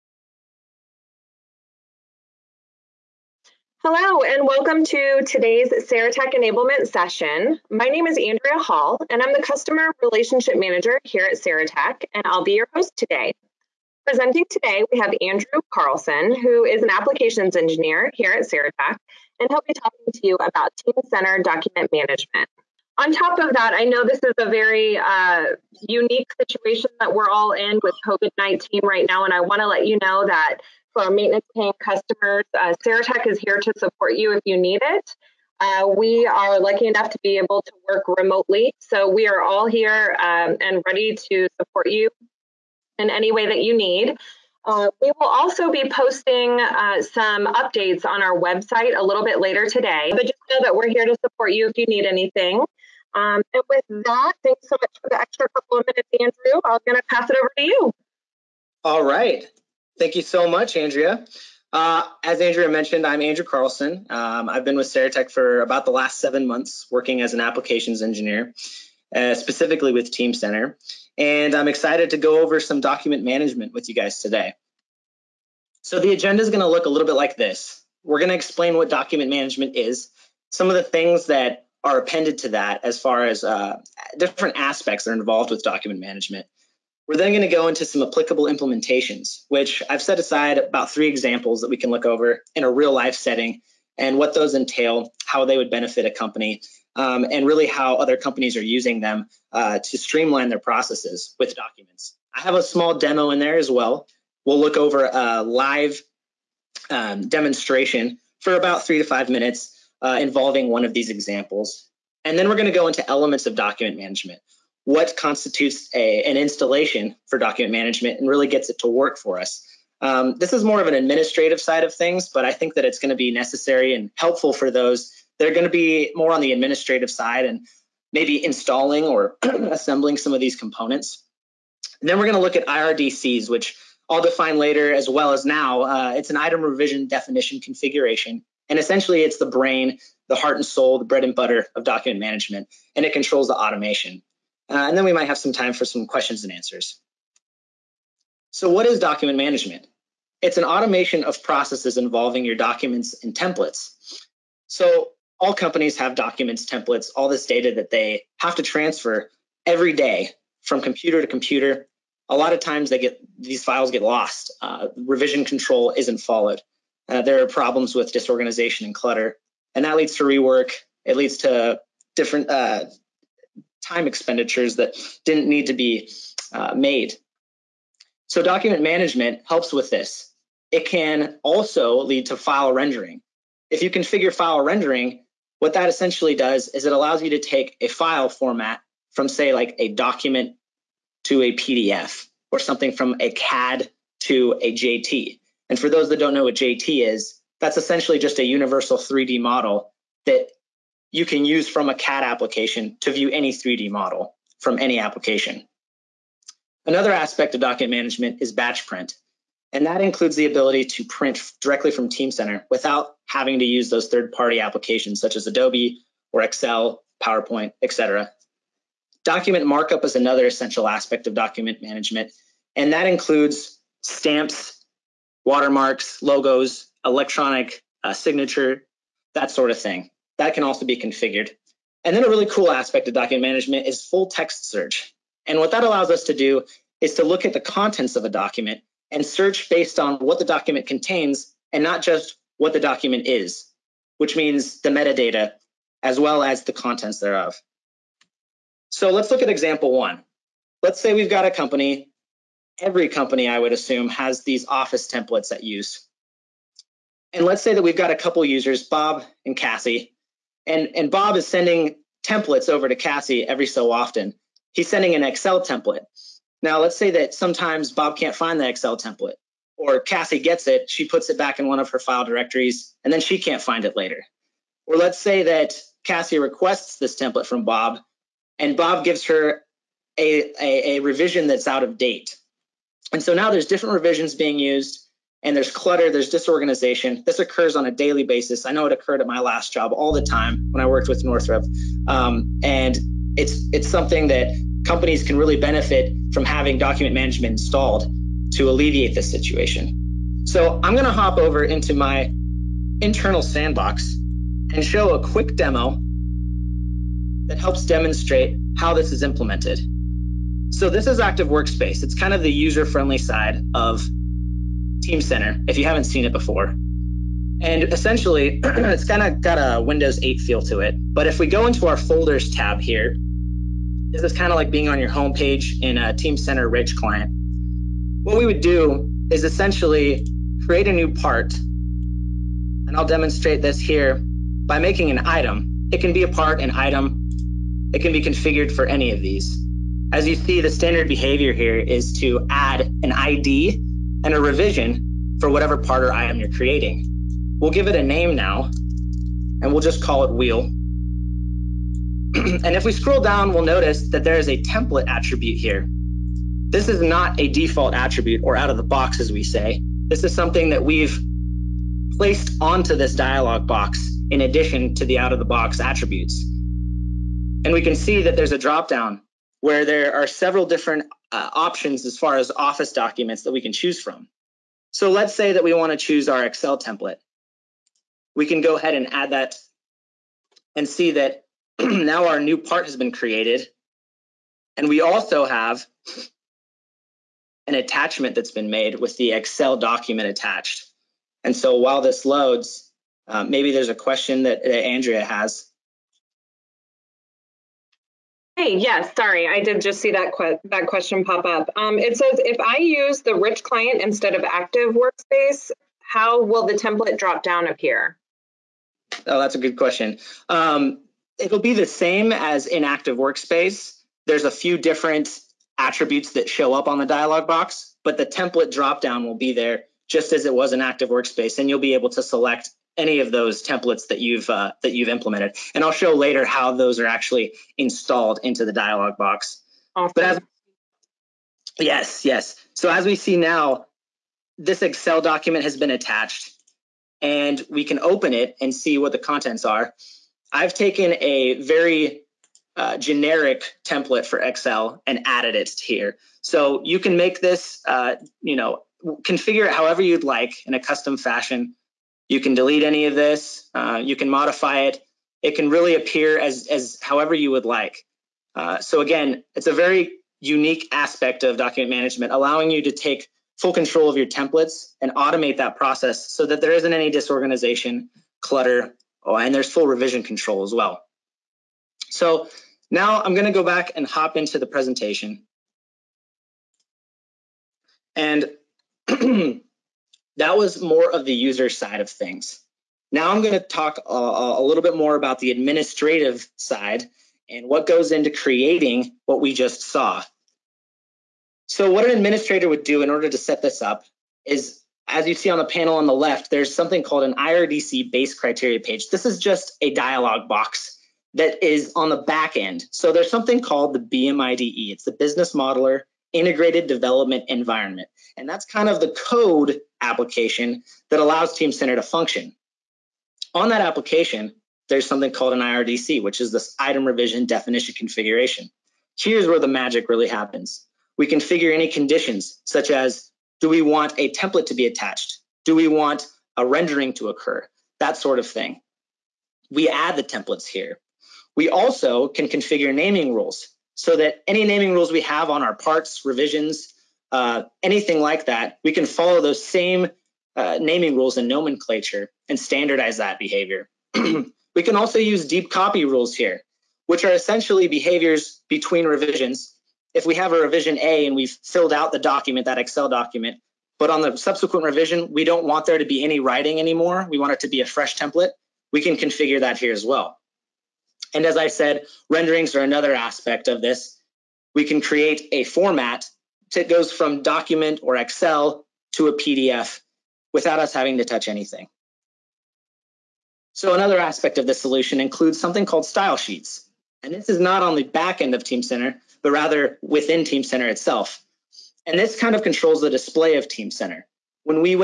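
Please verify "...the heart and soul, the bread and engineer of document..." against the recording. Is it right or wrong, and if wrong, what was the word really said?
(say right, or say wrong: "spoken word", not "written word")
wrong: "butter", not "engineer".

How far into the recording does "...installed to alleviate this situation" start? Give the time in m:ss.
4:57.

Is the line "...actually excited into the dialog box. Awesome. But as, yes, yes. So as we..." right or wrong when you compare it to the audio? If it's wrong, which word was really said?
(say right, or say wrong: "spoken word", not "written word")
wrong: "installed", not "excited".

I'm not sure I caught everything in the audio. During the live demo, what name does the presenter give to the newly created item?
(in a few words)
wheel.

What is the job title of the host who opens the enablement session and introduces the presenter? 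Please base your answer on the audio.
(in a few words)
Customer Relationship Manager.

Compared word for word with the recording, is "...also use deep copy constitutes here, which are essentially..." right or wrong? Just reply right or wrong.
wrong.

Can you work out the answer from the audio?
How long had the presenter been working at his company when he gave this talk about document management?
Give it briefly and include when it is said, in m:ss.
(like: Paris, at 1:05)
seven months, at 1:06.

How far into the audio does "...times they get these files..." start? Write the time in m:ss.
2:42.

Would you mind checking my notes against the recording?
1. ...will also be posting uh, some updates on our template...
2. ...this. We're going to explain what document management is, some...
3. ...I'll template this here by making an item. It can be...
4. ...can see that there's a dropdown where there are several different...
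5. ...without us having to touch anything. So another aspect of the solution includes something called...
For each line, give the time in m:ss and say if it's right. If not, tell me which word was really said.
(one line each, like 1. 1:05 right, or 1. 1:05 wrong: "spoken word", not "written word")
1. 0:45 wrong: "website", not "template"
2. 1:17 right
3. 5:32 wrong: "demonstrate", not "template"
4. 6:07 right
5. 9:30 right.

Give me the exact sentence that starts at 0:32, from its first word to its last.
Uh, Saratech is here to support you if you need it.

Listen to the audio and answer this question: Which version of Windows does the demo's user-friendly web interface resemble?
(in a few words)
Windows 8.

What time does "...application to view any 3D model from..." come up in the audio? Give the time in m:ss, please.
3:22.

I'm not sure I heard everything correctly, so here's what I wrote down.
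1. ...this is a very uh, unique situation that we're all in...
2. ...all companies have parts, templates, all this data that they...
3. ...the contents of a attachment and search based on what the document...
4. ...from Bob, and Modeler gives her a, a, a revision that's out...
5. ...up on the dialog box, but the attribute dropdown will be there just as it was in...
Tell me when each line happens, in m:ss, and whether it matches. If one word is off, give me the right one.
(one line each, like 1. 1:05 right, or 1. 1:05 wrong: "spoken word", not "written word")
1. 0:24 right
2. 2:35 wrong: "documents", not "parts"
3. 3:57 wrong: "document", not "attachment"
4. 4:37 wrong: "Bob", not "Modeler"
5. 6:56 wrong: "template", not "attribute".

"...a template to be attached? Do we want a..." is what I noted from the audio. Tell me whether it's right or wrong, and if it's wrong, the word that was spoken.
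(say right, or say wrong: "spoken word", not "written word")
right.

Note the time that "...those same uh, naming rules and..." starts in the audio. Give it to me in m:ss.
8:59.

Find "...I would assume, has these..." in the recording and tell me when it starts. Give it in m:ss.
4:13.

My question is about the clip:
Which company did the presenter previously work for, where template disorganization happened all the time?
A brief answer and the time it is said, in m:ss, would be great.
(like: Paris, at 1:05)
Northrop, at 4:51.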